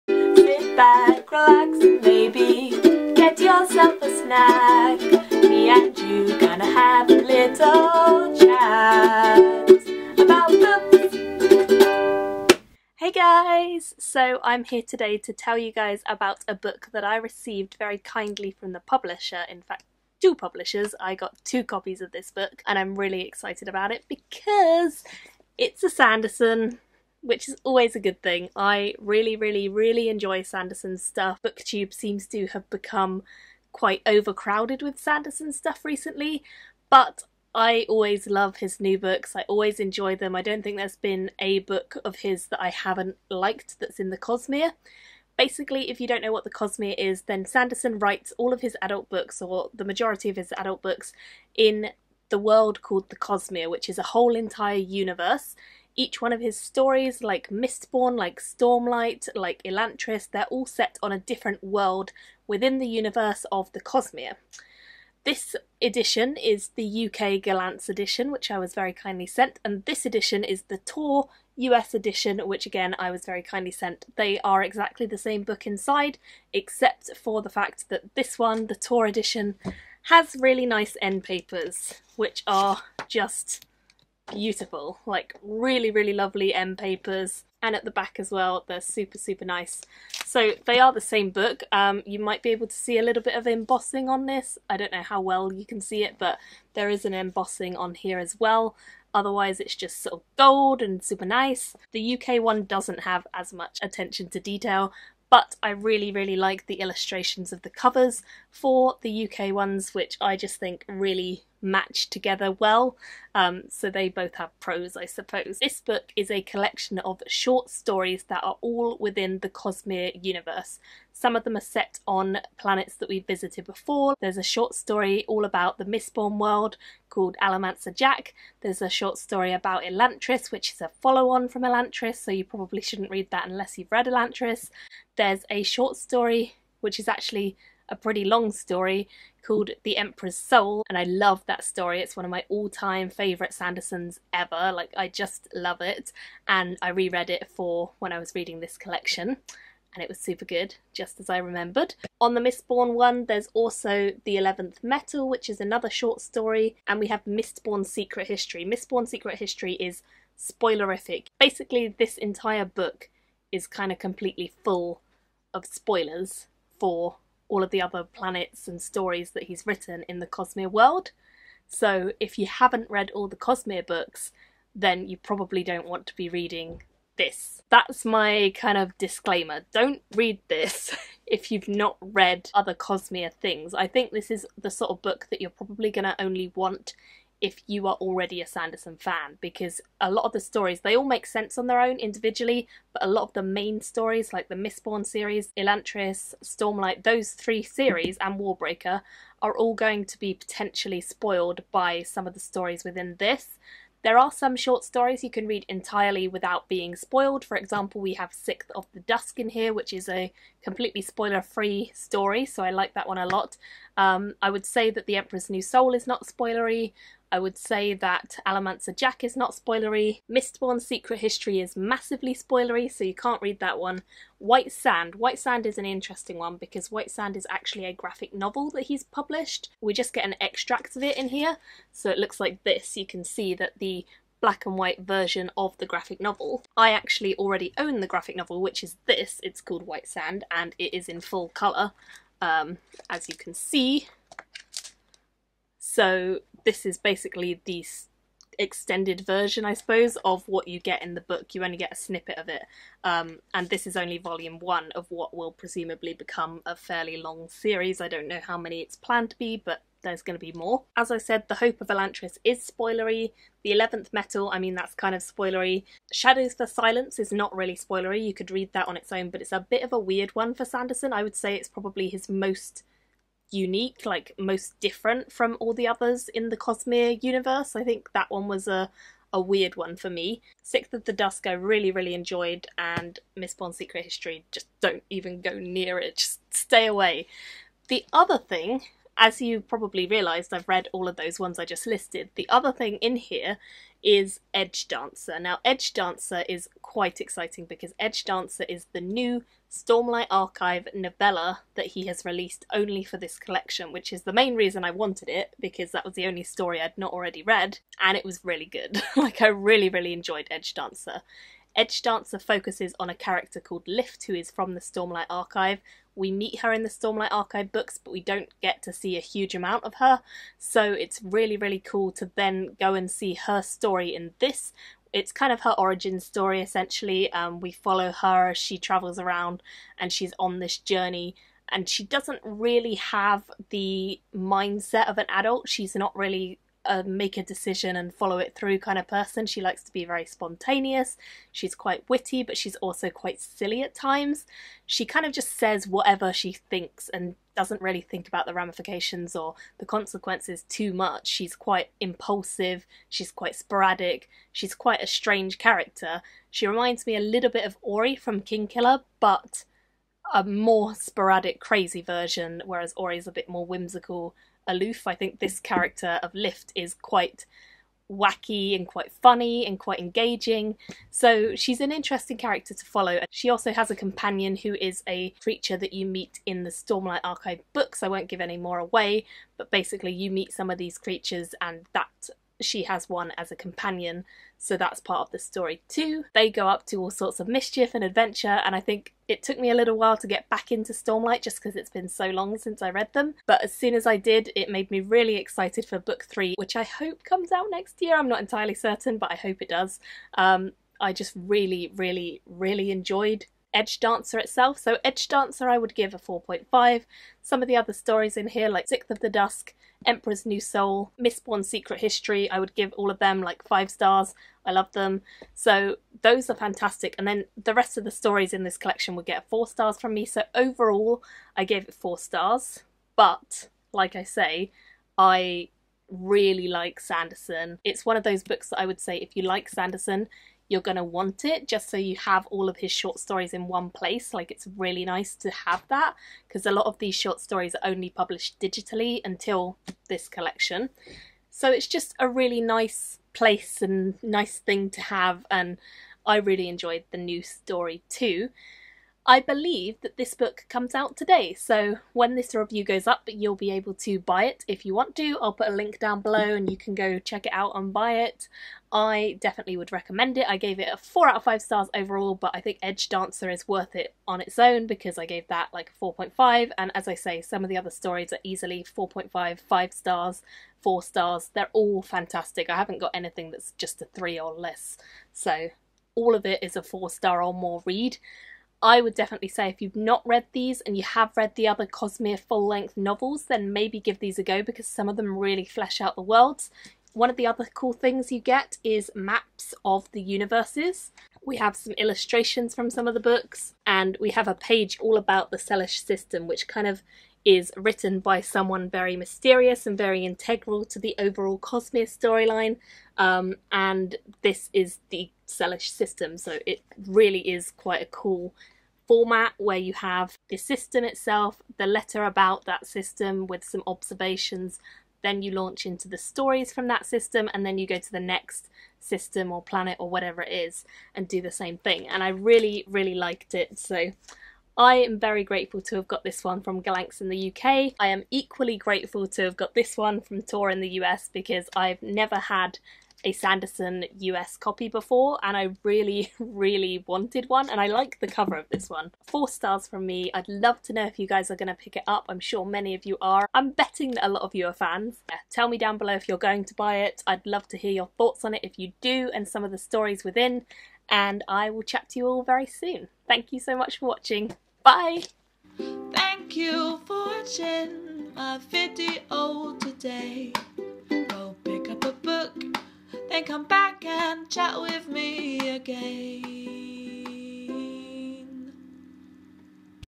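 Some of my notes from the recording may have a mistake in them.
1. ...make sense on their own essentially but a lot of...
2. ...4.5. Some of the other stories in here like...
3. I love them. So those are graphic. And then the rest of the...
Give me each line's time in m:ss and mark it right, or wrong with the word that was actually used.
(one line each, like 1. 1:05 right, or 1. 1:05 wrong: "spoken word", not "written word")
1. 3:11 wrong: "individually", not "essentially"
2. 6:46 right
3. 6:54 wrong: "fantastic", not "graphic".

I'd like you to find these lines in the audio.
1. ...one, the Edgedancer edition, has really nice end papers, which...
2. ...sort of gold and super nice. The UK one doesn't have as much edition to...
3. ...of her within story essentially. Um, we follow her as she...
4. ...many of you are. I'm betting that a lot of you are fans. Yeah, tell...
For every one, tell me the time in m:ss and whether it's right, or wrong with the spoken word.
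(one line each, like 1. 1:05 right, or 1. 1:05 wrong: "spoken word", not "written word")
1. 1:18 wrong: "Tor", not "Edgedancer"
2. 1:40 wrong: "attention", not "edition"
3. 5:25 wrong: "origin", not "within"
4. 9:02 right.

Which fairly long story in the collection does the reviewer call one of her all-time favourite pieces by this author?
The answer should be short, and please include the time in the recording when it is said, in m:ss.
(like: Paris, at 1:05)
The Emperor's Soul, at 2:19.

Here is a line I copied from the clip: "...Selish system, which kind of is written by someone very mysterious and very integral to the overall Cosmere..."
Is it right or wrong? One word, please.
right.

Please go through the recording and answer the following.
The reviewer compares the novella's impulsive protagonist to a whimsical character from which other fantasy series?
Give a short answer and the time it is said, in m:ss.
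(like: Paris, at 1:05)
Kingkiller, at 5:58.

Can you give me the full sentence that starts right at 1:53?
Um, so they both have pros, I suppose.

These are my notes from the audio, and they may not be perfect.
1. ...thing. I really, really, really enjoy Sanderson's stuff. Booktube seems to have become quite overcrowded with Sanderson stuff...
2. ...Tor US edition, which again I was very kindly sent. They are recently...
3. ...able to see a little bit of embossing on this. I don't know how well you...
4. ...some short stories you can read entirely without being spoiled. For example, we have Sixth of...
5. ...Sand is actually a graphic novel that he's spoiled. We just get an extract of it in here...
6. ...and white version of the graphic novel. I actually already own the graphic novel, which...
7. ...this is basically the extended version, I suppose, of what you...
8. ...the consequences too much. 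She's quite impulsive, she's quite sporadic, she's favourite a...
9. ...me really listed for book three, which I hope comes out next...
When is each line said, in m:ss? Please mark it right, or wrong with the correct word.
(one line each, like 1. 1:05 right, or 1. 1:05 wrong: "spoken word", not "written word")
1. 0:28 right
2. 1:10 wrong: "exactly", not "recently"
3. 1:32 right
4. 3:24 right
5. 3:47 wrong: "published", not "spoiled"
6. 3:54 right
7. 4:06 right
8. 5:49 wrong: "quite", not "favourite"
9. 6:34 wrong: "excited", not "listed".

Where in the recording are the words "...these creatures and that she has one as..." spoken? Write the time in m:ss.
6:20.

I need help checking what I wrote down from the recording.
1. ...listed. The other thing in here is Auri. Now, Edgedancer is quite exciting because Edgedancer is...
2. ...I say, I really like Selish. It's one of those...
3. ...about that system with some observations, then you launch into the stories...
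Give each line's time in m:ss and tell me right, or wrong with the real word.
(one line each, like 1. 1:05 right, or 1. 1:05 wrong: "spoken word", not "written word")
1. 4:51 wrong: "Edgedancer", not "Auri"
2. 7:04 wrong: "Sanderson", not "Selish"
3. 8:32 right.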